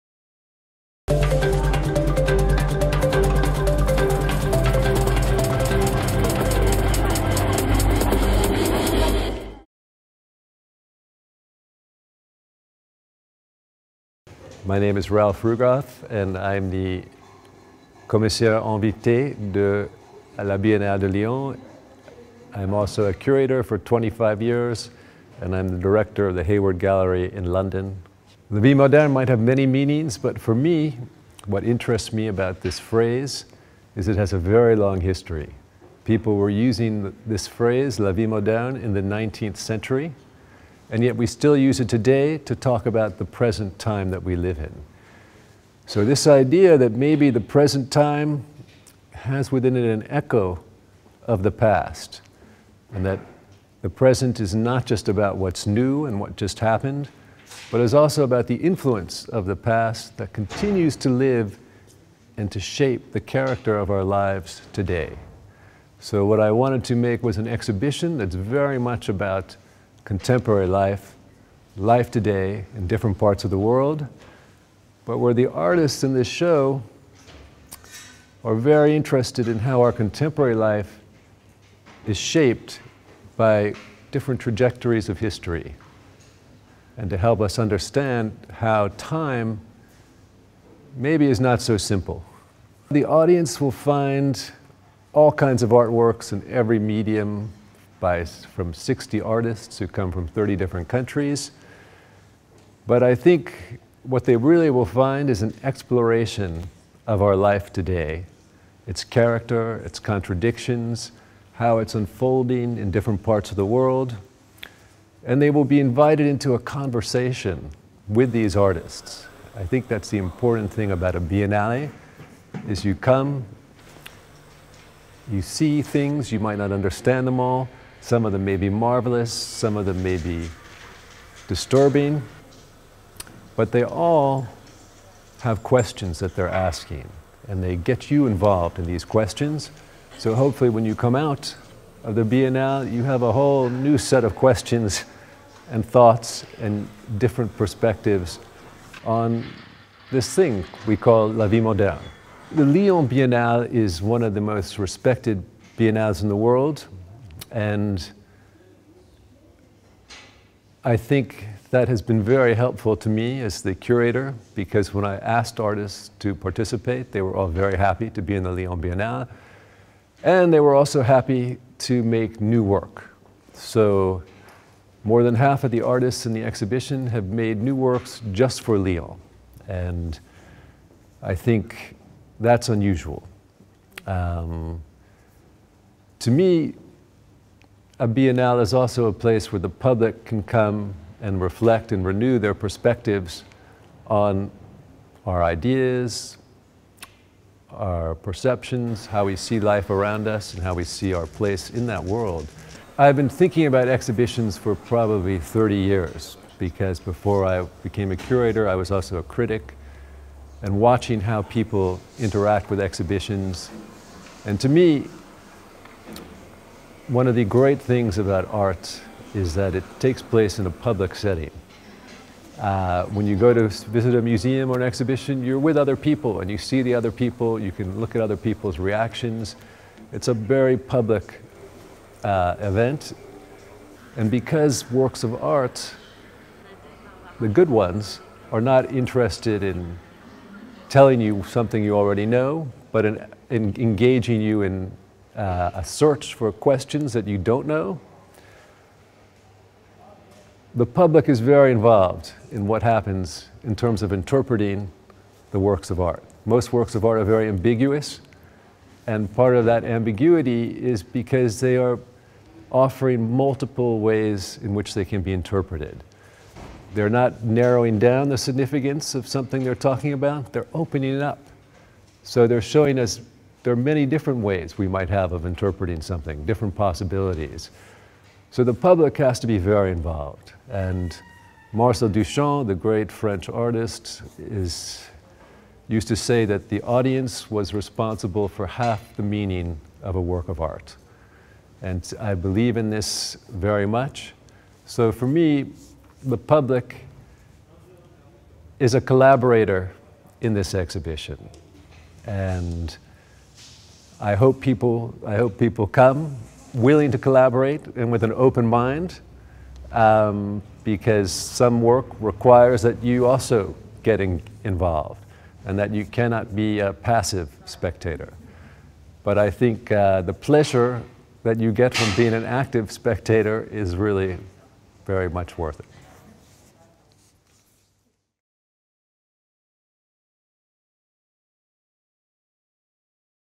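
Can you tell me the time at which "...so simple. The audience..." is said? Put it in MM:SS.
01:31.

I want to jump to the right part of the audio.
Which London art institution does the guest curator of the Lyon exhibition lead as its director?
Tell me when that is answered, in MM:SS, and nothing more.
00:26.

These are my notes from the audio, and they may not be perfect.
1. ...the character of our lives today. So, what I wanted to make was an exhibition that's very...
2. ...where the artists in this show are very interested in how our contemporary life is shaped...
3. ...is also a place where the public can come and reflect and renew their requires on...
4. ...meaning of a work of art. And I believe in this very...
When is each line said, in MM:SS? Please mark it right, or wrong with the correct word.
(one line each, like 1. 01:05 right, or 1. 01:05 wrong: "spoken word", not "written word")
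1. 01:03 right
2. 01:15 right
3. 03:08 wrong: "perspectives", not "requires"
4. 04:49 right.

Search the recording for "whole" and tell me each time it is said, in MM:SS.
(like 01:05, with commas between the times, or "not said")
02:23.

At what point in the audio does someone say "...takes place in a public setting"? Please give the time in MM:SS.
03:39.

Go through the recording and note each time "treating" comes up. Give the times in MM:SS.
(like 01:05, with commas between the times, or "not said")
not said.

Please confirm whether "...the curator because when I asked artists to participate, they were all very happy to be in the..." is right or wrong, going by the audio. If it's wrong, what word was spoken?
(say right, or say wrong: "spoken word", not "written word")
right.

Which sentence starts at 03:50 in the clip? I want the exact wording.
It's a very public uh, event.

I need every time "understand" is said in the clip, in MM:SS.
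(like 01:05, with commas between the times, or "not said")
01:27, 02:06.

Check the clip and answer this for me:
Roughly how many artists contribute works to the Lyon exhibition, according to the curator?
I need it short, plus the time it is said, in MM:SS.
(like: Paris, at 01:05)
60, at 01:38.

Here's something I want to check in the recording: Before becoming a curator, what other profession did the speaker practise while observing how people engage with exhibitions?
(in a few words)
critic.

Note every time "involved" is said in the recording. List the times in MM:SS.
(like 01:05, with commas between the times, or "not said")
02:18, 04:11, 04:39, 05:14.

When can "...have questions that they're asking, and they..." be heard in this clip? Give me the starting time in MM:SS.
02:15.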